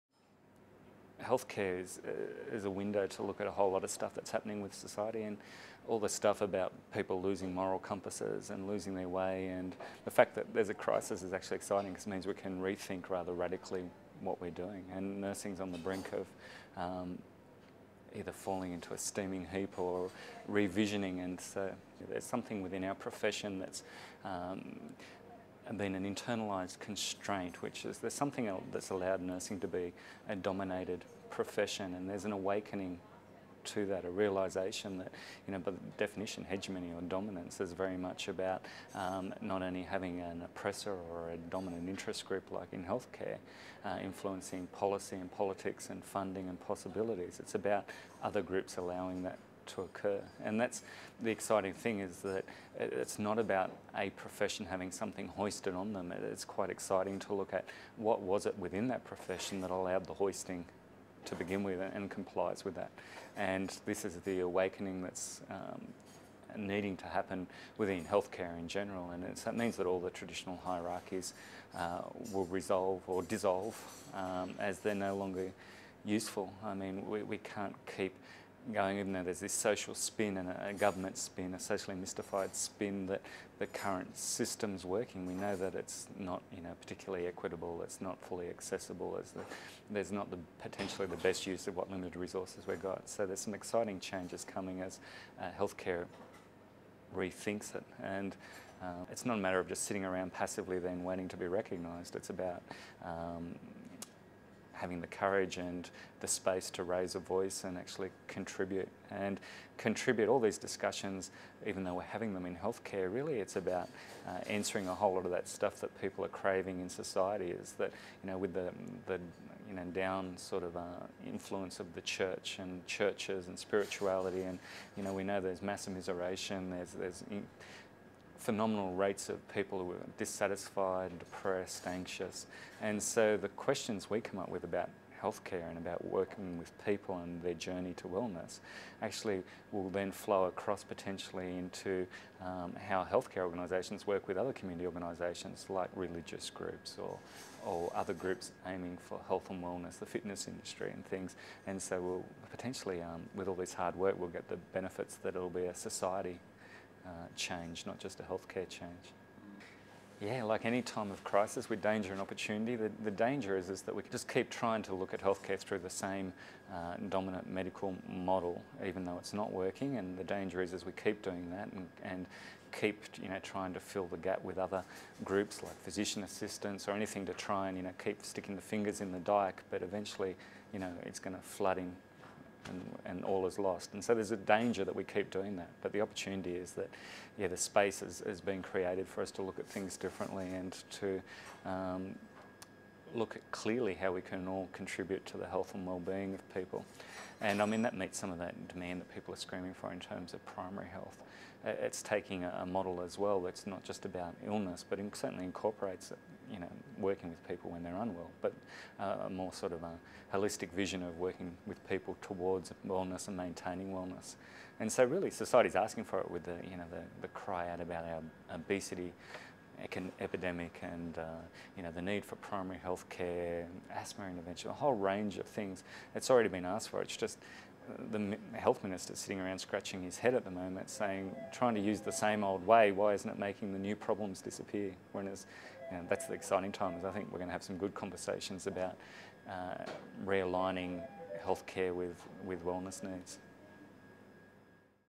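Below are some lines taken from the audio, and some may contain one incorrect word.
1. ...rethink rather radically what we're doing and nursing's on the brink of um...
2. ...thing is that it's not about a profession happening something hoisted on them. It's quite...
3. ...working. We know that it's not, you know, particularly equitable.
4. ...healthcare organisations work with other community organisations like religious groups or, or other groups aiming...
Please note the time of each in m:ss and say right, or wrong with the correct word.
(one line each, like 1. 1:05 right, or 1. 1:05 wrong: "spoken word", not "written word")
1. 0:12 right
2. 0:51 wrong: "having", not "happening"
3. 1:24 right
4. 2:23 right.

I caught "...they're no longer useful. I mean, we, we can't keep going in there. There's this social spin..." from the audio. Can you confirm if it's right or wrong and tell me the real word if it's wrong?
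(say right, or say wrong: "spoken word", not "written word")
right.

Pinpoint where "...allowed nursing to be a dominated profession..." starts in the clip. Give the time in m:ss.
0:28.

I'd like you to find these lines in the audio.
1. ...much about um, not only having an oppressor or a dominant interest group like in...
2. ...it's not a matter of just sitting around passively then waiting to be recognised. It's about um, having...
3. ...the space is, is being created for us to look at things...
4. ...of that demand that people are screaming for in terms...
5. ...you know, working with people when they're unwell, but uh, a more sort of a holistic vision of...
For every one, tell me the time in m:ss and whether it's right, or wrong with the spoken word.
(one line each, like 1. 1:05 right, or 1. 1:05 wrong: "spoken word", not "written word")
1. 0:37 right
2. 1:39 right
3. 3:07 right
4. 3:18 right
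5. 3:26 right.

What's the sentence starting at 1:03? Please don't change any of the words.
And this is the awakening that's um, needing to happen within healthcare in general.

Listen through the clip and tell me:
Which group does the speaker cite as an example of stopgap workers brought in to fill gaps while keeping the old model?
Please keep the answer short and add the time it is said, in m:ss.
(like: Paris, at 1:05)
Physician assistants, at 2:55.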